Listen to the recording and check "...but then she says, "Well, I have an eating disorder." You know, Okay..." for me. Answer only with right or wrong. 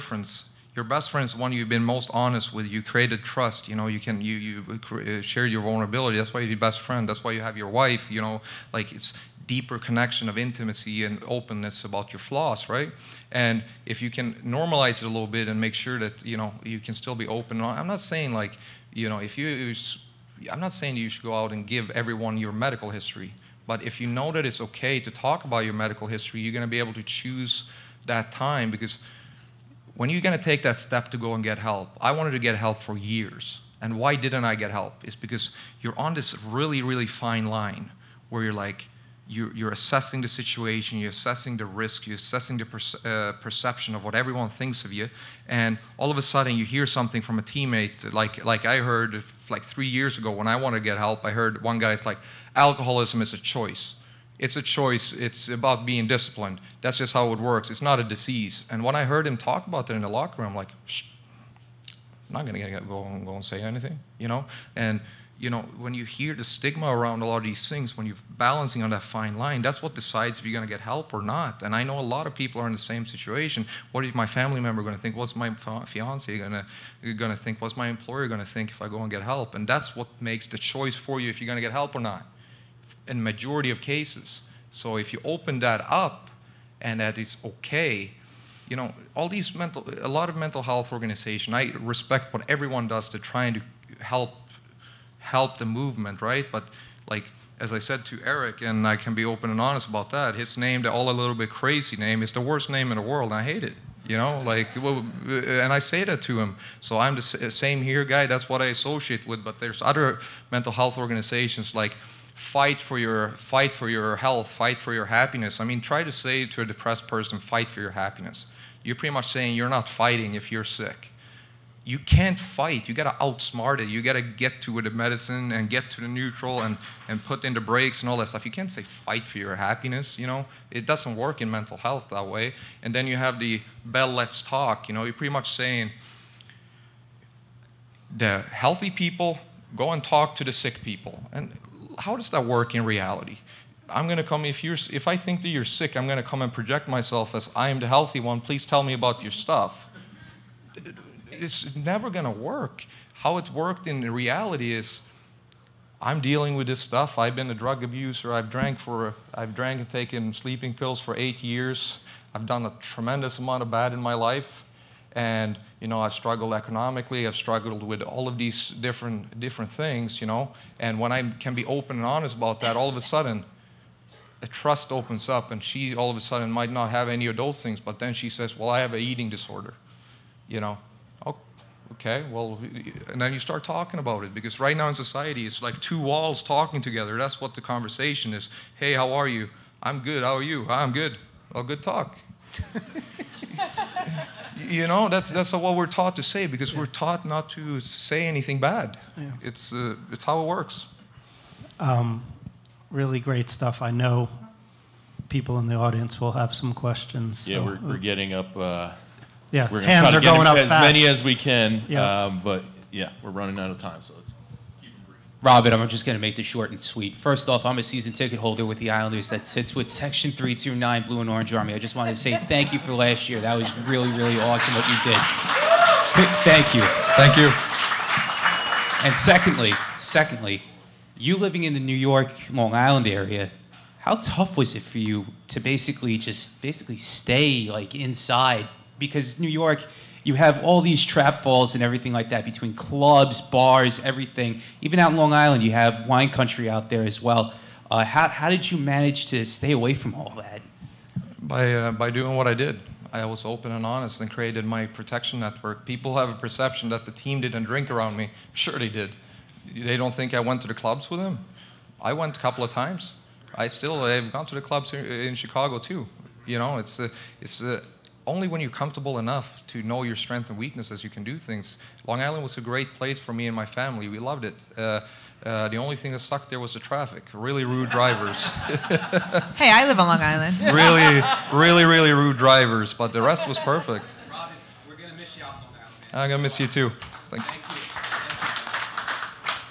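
right.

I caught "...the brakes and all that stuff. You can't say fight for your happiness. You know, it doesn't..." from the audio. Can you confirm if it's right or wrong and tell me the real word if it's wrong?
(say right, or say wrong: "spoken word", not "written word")
right.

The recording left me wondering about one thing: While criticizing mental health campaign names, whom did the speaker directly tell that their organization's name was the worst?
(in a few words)
Eric.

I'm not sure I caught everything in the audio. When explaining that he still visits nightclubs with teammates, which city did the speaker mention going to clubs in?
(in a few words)
Chicago.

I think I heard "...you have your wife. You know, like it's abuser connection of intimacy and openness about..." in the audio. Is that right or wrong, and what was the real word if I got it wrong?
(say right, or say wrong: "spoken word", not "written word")
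wrong: "deeper", not "abuser".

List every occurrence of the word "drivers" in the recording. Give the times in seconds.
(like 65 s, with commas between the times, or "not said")
277 s, 282 s.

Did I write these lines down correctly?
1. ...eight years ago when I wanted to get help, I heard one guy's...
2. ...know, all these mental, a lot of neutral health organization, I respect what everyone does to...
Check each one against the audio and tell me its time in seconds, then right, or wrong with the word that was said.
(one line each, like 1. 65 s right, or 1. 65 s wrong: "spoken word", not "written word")
1. 49 s wrong: "three", not "eight"
2. 88 s wrong: "mental", not "neutral".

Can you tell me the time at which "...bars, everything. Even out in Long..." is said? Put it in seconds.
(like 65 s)
243 s.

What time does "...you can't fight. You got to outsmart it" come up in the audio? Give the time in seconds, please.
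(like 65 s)
121 s.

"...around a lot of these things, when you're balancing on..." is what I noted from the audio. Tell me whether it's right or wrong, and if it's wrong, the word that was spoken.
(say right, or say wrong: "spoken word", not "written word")
right.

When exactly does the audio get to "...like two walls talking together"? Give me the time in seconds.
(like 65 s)
185 s.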